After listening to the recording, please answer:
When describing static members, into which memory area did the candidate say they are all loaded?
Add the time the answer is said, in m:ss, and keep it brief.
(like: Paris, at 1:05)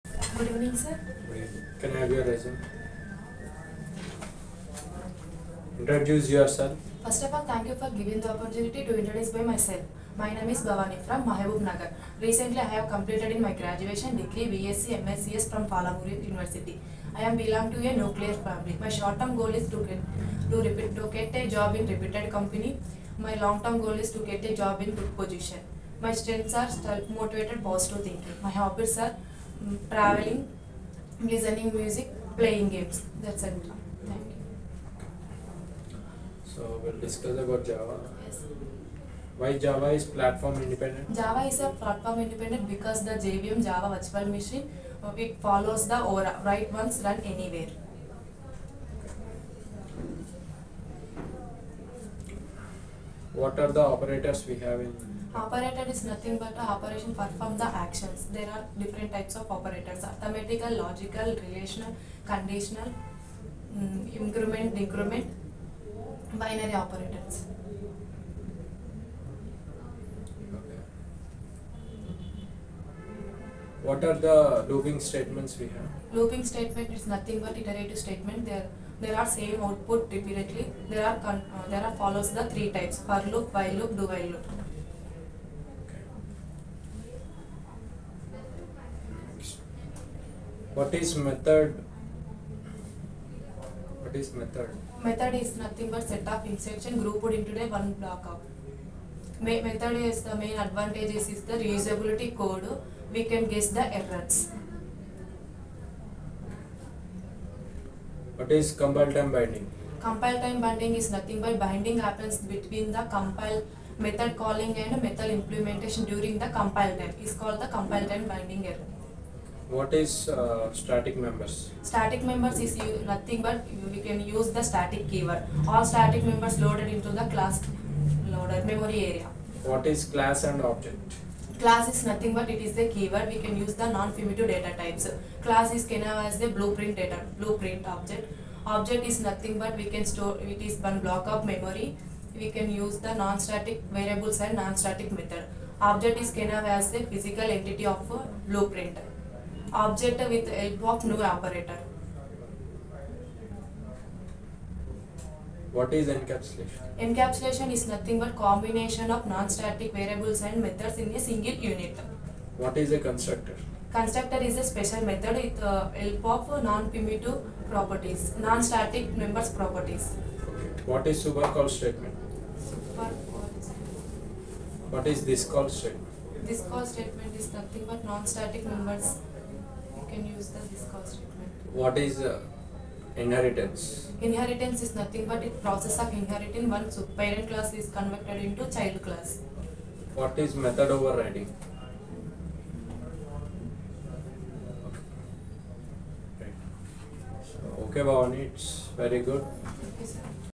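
Class loader memory area, at 2:07.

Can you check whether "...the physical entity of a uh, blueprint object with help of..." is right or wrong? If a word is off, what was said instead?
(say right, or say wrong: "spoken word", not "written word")
right.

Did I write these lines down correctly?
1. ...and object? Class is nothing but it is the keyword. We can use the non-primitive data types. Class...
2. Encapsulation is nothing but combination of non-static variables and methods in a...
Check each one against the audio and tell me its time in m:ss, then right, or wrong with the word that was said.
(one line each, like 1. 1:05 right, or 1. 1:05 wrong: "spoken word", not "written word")
1. 2:10 right
2. 2:36 right.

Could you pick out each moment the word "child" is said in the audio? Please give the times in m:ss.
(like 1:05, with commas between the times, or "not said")
3:08.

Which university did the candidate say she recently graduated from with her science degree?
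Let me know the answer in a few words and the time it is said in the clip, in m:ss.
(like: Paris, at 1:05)
Palamur University, at 0:15.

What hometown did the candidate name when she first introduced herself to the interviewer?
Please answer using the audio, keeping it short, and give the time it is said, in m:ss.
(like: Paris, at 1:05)
Mahabub Nagar, at 0:11.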